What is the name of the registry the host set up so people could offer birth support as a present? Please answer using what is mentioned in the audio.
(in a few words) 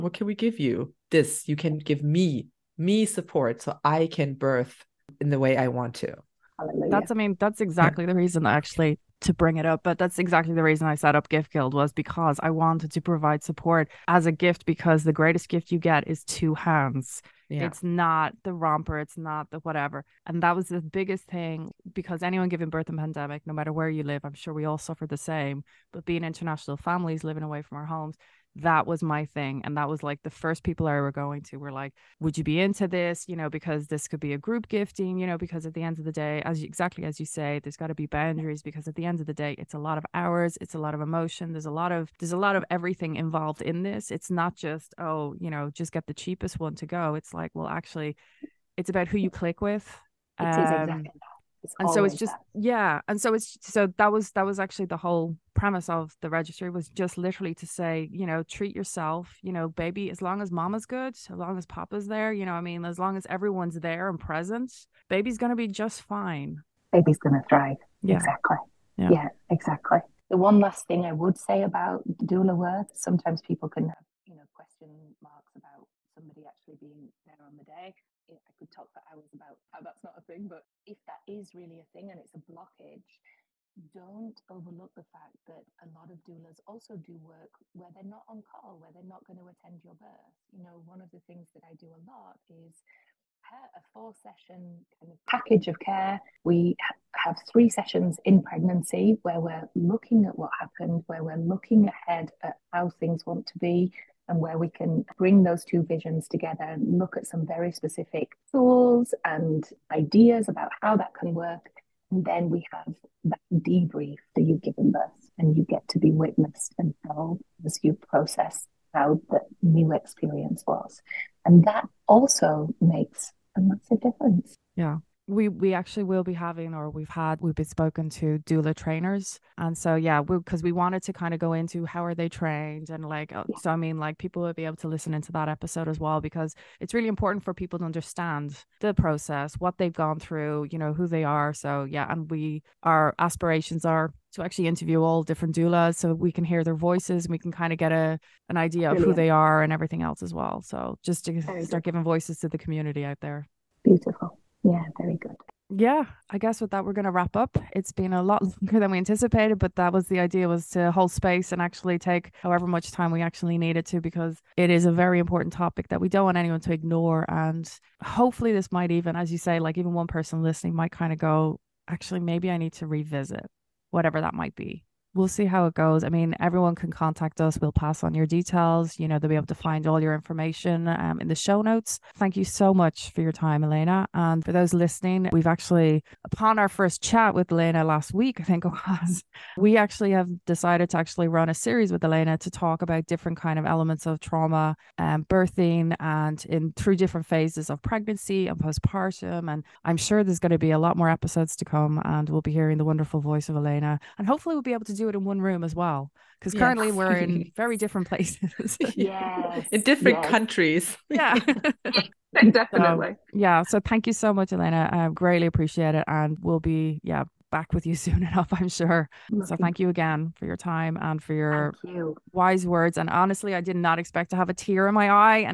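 Gift Guild.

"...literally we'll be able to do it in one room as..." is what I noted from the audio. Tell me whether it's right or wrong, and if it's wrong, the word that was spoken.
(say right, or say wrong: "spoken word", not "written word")
wrong: "hopefully", not "literally".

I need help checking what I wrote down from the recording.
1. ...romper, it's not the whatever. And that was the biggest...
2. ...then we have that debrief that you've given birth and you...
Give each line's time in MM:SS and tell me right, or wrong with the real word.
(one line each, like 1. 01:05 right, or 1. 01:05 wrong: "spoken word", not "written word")
1. 00:18 right
2. 01:52 right.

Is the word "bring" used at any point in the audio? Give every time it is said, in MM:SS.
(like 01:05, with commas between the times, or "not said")
00:09, 01:45.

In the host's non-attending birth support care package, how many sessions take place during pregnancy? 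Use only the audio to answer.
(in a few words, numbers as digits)
3.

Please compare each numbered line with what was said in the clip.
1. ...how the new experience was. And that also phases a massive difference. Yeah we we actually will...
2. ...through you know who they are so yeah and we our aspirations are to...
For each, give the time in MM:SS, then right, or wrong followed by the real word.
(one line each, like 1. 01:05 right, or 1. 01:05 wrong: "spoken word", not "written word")
1. 01:58 wrong: "makes", not "phases"
2. 02:20 right.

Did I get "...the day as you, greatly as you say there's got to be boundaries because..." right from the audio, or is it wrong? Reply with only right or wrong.
wrong.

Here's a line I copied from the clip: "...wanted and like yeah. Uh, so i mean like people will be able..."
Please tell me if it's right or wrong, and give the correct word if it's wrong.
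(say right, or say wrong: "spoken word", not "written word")
wrong: "trained", not "wanted".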